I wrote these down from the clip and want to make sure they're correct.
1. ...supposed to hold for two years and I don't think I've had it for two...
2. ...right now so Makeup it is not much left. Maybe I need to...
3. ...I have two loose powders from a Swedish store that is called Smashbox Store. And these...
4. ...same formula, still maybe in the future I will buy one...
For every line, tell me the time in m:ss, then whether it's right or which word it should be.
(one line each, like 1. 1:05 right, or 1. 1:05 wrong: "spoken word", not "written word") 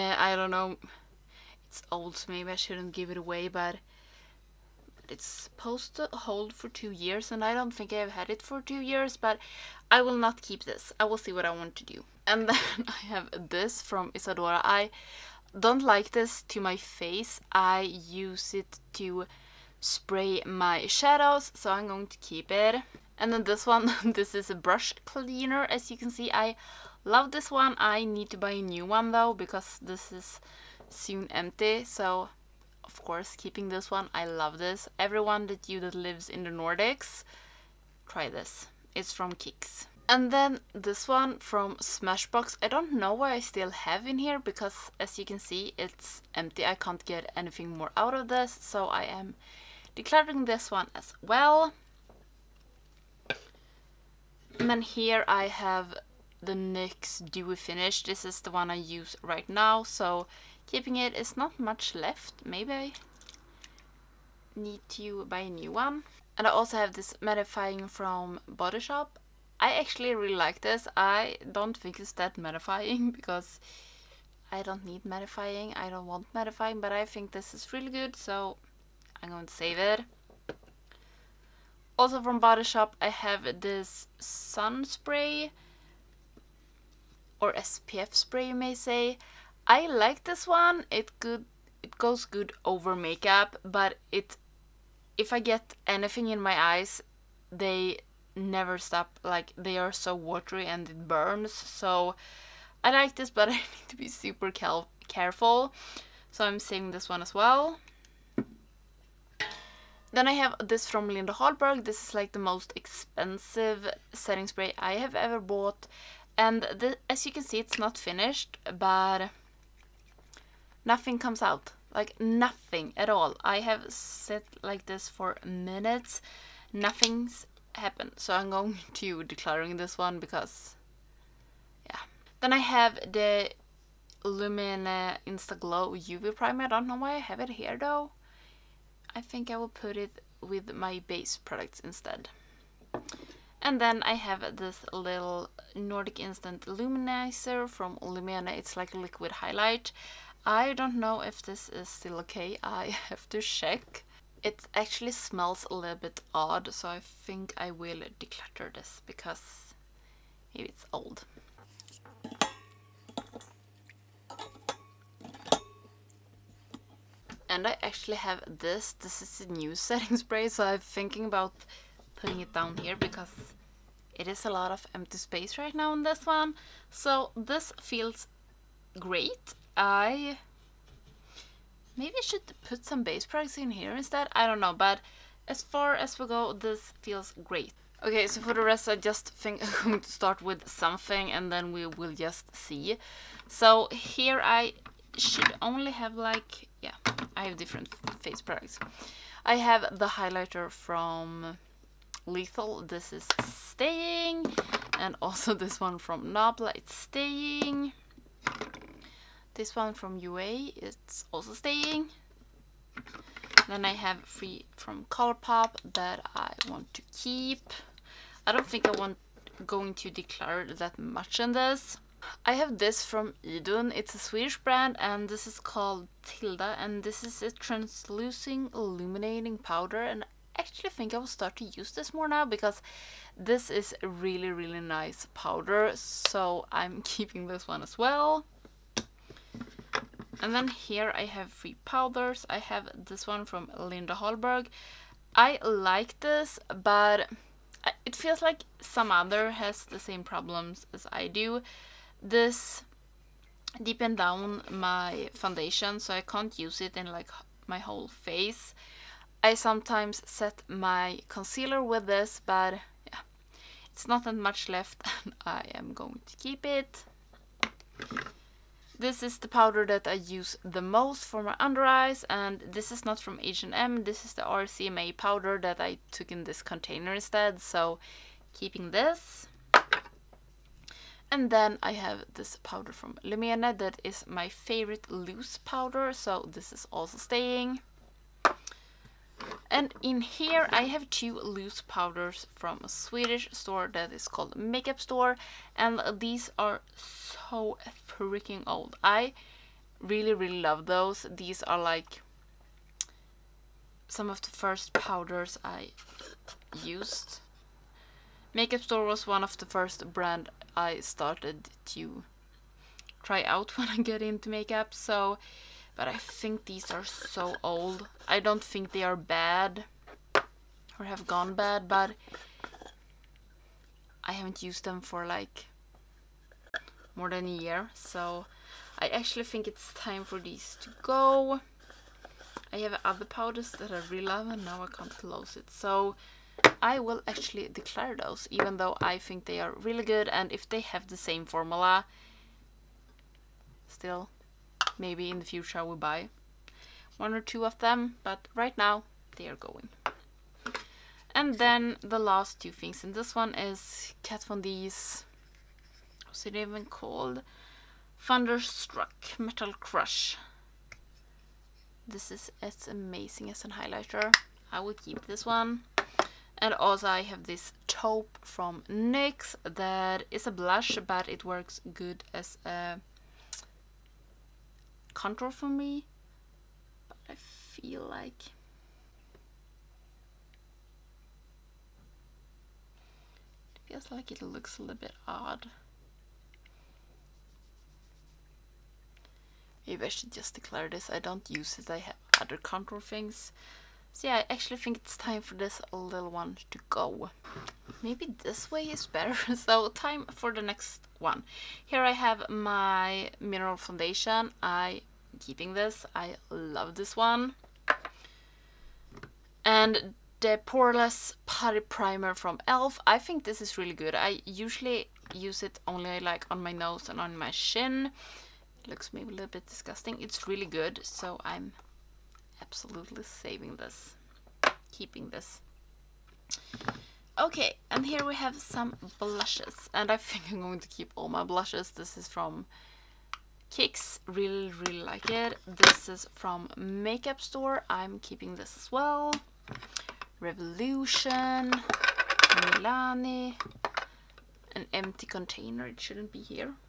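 1. 0:05 right
2. 0:59 wrong: "Keeping", not "Makeup"
3. 4:50 wrong: "Makeup", not "Smashbox"
4. 5:41 right.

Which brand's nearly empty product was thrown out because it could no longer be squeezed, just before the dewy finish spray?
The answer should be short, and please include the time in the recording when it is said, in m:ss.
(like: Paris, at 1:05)
Smashbox, at 0:41.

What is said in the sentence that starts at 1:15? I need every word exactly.
I don't want mattifying, but I think this is really good, so I'm going to save it.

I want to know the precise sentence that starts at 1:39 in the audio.
Like they are so watery and it burns.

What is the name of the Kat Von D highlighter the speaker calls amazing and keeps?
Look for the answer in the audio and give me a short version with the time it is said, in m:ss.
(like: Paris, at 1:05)
Thunderstruck Metal Crush, at 5:58.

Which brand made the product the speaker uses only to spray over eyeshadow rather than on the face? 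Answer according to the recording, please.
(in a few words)
Isadora.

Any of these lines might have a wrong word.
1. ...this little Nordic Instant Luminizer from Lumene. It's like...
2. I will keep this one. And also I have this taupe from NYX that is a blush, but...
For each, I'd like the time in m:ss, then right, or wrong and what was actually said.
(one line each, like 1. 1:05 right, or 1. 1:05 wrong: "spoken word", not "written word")
1. 2:24 right
2. 6:04 right.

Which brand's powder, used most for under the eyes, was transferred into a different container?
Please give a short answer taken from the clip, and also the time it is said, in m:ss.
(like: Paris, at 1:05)
RCMA, at 4:34.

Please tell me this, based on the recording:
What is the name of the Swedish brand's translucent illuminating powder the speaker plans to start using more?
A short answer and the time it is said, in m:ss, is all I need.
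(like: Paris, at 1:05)
Tilda, at 3:46.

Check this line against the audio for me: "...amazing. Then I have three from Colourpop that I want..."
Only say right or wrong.
wrong.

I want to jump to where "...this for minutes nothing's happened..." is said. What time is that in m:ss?
2:04.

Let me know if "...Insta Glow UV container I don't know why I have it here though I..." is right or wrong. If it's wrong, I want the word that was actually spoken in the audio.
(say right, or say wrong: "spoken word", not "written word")
wrong: "primer", not "container".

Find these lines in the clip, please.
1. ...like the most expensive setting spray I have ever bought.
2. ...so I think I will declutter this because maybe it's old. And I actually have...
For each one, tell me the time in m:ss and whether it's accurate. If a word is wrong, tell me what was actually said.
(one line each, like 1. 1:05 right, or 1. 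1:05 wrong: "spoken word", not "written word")
1. 1:52 right
2. 2:36 right.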